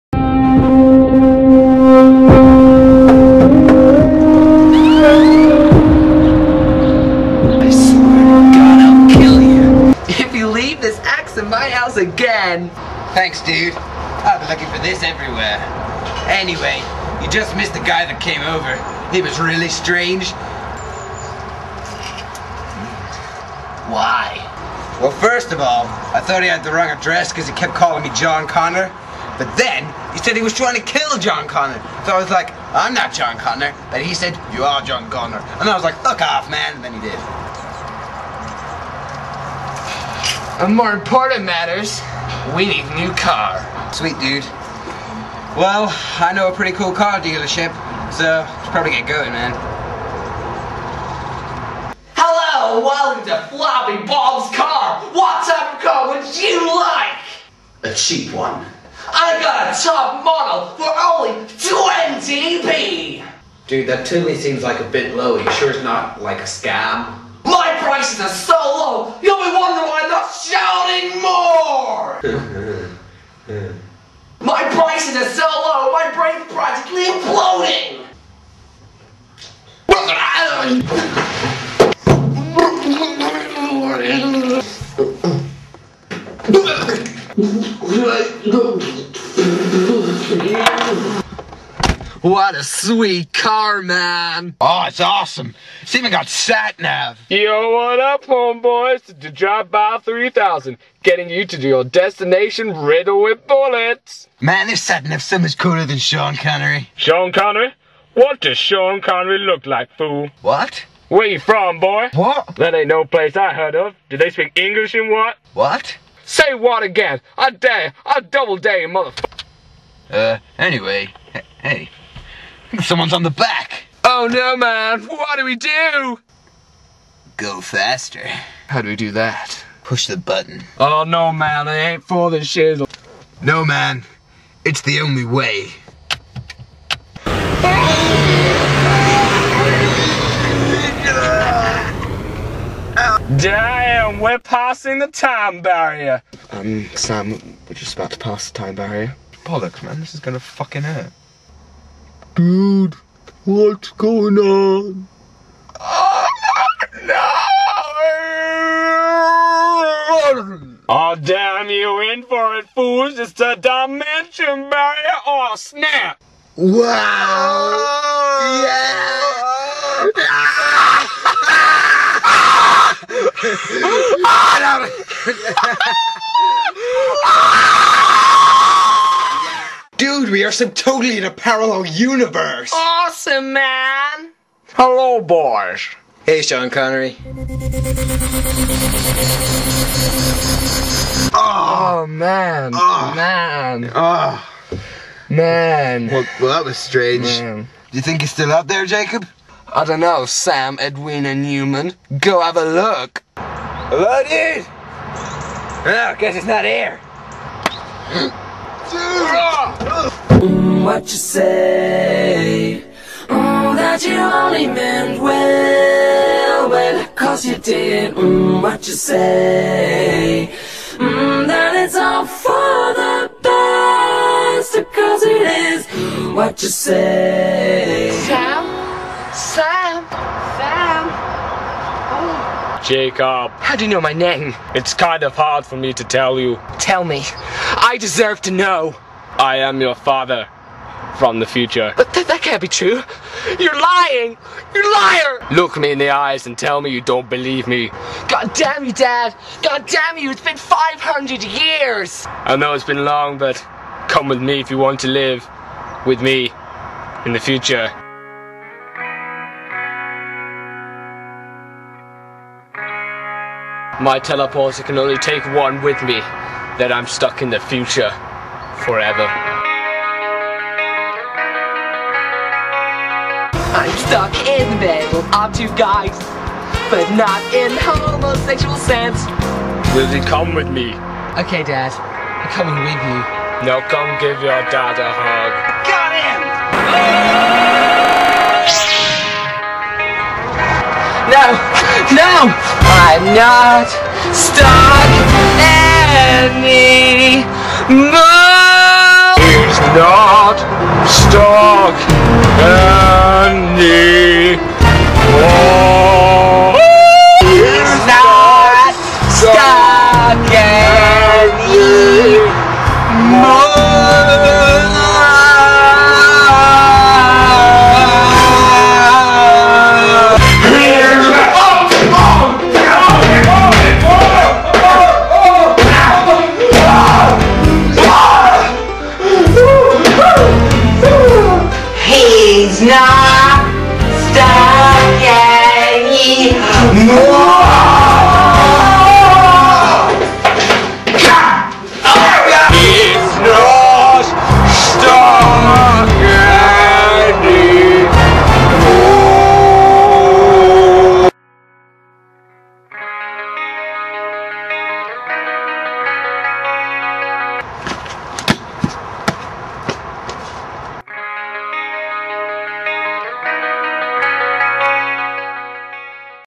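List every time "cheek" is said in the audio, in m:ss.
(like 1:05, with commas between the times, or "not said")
not said.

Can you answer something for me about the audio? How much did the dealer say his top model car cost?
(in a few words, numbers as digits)
20p.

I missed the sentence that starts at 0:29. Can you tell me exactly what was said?
But then, he said he was trying to kill John Connor.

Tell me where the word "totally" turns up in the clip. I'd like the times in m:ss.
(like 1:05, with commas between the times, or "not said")
1:04, 3:00.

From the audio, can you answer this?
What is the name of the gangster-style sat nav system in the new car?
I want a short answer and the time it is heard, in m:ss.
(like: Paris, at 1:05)
Drive By 3000, at 1:39.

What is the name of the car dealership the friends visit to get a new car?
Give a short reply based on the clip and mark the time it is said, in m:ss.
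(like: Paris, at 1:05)
Floppy Bob's, at 0:53.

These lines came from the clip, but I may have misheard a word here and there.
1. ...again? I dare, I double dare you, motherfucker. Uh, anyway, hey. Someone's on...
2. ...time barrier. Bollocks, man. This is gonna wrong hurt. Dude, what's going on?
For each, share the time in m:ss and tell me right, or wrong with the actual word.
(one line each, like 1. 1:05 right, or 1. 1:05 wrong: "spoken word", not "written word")
1. 1:56 right
2. 2:28 wrong: "fucking", not "wrong".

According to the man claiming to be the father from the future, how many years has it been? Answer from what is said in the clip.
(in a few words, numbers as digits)
500.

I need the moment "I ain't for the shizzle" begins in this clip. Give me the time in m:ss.
2:11.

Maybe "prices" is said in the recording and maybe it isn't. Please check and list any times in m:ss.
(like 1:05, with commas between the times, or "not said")
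1:07, 1:14.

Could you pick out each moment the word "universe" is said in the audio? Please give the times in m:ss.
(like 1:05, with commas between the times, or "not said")
3:01.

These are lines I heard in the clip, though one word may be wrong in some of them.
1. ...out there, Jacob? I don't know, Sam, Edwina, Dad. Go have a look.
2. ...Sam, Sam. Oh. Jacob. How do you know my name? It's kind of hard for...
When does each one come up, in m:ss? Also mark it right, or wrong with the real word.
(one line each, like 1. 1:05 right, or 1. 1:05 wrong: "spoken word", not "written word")
1. 3:18 wrong: "Newman", not "Dad"
2. 3:49 right.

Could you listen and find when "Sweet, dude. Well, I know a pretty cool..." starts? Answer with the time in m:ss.
0:43.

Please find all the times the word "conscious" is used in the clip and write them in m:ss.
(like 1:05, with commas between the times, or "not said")
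not said.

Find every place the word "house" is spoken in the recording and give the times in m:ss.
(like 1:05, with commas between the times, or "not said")
0:11.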